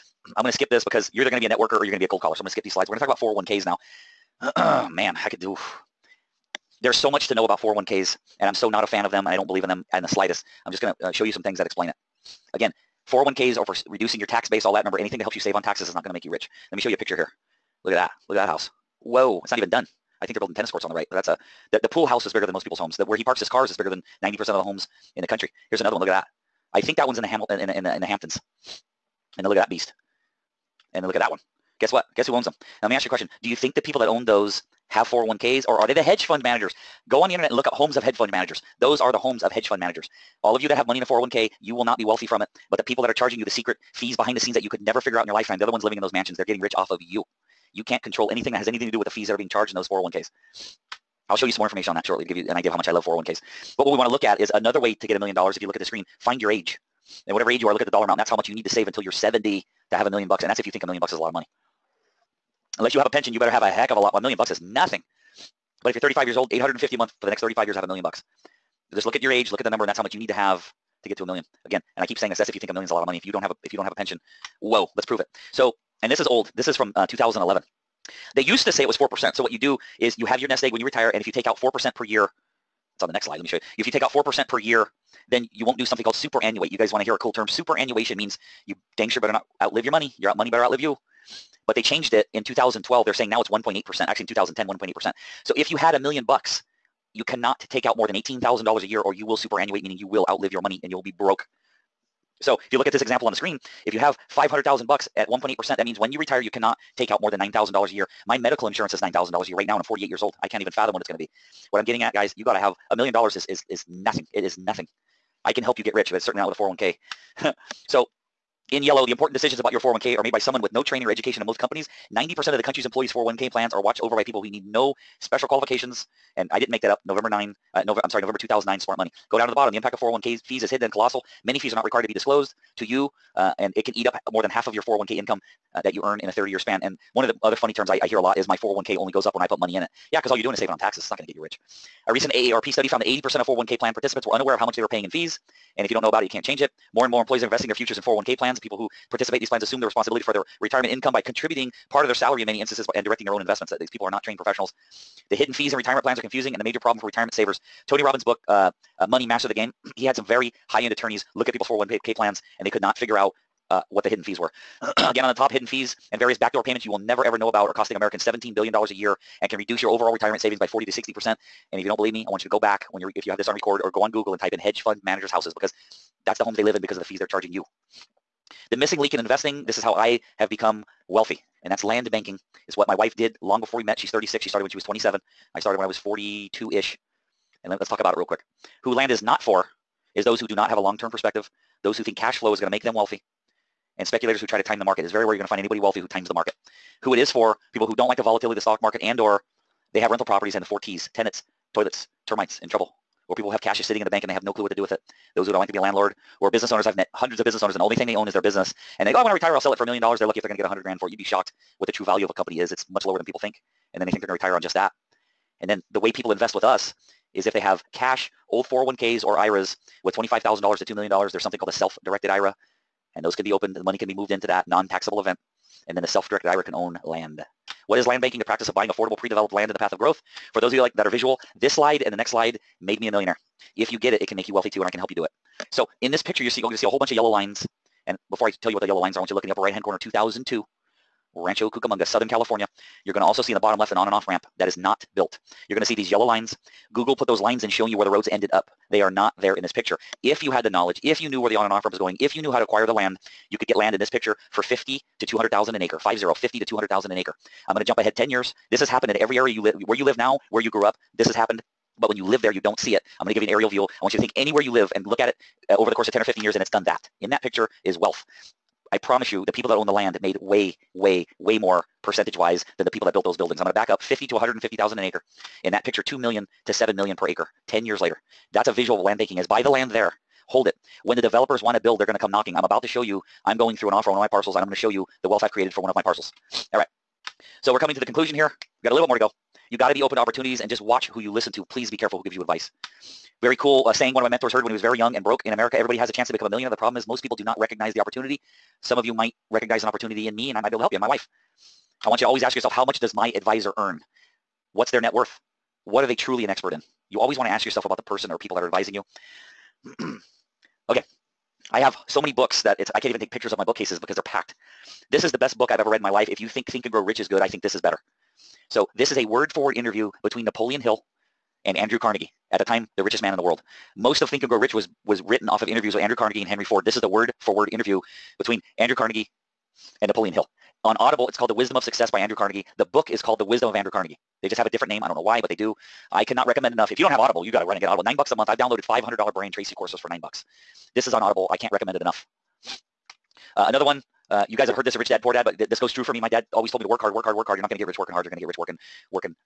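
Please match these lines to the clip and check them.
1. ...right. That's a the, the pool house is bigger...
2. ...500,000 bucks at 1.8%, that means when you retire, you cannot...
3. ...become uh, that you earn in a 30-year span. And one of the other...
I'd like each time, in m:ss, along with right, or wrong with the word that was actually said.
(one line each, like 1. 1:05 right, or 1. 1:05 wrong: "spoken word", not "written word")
1. 0:20 right
2. 1:44 right
3. 2:15 wrong: "income", not "become".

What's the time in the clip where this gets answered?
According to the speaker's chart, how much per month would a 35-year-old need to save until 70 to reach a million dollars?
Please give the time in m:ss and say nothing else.
1:06.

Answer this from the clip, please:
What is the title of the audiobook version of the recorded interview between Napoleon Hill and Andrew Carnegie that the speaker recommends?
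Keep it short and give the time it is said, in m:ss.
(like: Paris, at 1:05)
The Wisdom of Success, at 5:31.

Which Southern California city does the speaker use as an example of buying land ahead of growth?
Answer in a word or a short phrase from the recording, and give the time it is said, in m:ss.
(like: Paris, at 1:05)
Rancho Cucamonga, at 4:01.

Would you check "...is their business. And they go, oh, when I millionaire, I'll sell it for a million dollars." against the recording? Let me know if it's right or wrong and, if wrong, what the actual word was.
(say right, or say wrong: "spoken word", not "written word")
wrong: "retire", not "millionaire".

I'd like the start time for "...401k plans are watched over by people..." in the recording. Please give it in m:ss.
2:03.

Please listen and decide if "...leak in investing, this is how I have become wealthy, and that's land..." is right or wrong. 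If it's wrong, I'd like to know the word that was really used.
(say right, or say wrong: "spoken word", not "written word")
right.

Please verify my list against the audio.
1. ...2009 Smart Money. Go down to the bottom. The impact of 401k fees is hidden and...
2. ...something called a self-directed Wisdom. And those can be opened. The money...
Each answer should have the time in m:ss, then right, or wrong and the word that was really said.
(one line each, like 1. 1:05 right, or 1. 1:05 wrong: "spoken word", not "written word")
1. 2:08 right
2. 3:41 wrong: "IRA", not "Wisdom".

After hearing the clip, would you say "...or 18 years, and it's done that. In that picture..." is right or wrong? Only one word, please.
wrong.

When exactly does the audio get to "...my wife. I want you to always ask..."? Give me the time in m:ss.
5:01.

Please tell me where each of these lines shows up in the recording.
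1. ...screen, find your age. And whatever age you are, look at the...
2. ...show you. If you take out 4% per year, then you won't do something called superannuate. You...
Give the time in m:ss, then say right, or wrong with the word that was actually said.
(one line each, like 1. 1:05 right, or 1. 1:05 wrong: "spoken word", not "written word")
1. 0:55 right
2. 1:23 right.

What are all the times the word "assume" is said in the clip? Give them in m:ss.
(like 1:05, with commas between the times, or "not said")
2:29.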